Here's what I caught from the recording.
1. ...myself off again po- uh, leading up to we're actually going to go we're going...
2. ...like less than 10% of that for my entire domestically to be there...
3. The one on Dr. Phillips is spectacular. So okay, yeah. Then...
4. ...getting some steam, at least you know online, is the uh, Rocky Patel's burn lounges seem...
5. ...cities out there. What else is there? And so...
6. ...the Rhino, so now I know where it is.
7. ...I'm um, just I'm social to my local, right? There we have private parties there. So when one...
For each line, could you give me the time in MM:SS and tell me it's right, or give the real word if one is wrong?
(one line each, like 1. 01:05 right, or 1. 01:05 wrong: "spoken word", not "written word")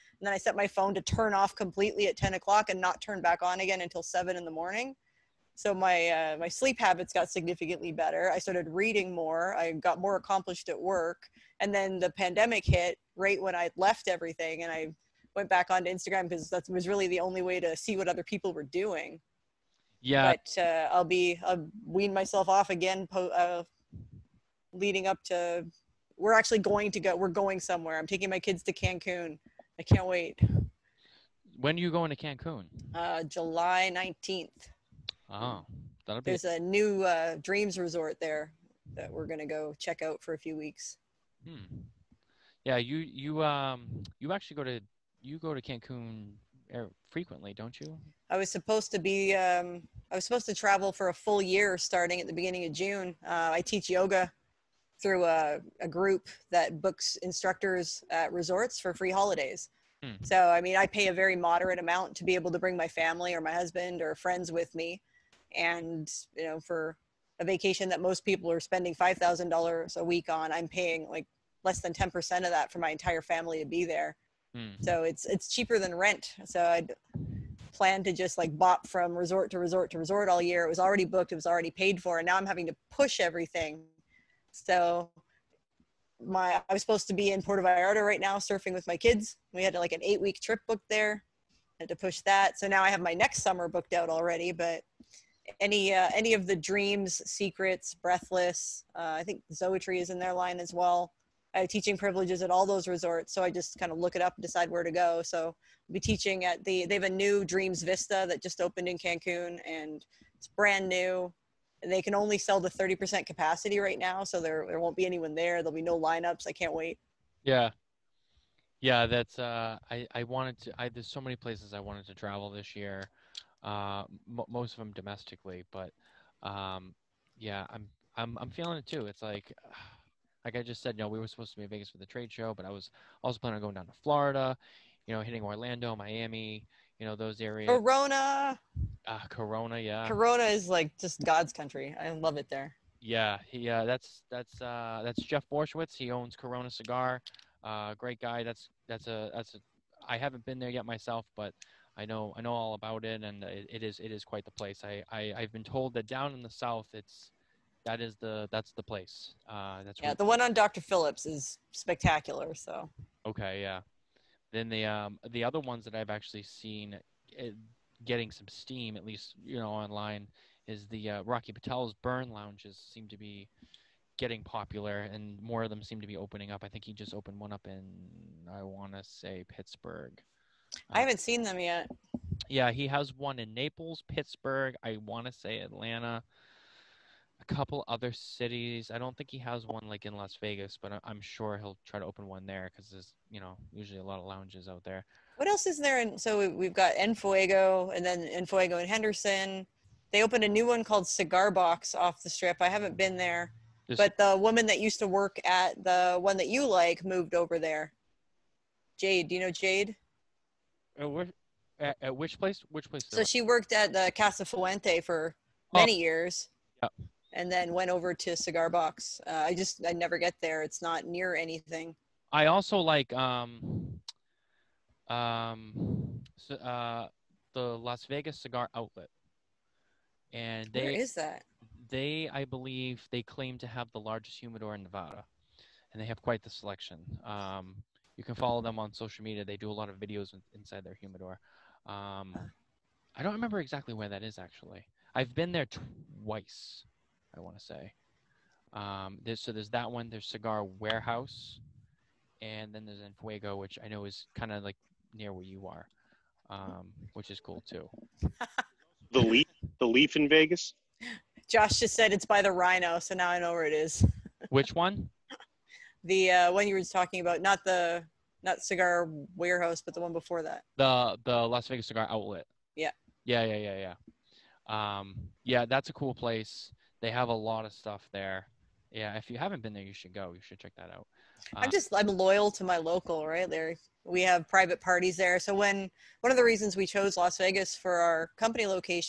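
1. 00:22 right
2. 01:11 wrong: "family", not "domestically"
3. 02:40 right
4. 02:48 right
5. 03:14 wrong: "lounges", not "cities"
6. 04:22 right
7. 04:41 wrong: "loyal", not "social".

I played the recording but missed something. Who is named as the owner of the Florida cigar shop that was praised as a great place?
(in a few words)
Jeff Borysiewicz.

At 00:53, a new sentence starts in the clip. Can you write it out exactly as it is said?
Uh, I teach yoga through a, a, group that books instructors at resorts for free holidays.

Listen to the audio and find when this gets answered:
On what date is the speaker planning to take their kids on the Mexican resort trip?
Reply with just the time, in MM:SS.
00:33.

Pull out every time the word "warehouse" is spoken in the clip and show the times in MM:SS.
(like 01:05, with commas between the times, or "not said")
04:10, 04:29.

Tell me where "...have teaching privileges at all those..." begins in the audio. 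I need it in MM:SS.
01:41.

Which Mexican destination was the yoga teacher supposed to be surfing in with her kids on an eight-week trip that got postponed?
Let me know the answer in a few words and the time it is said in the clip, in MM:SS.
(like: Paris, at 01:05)
Puerto Vallarta, at 01:27.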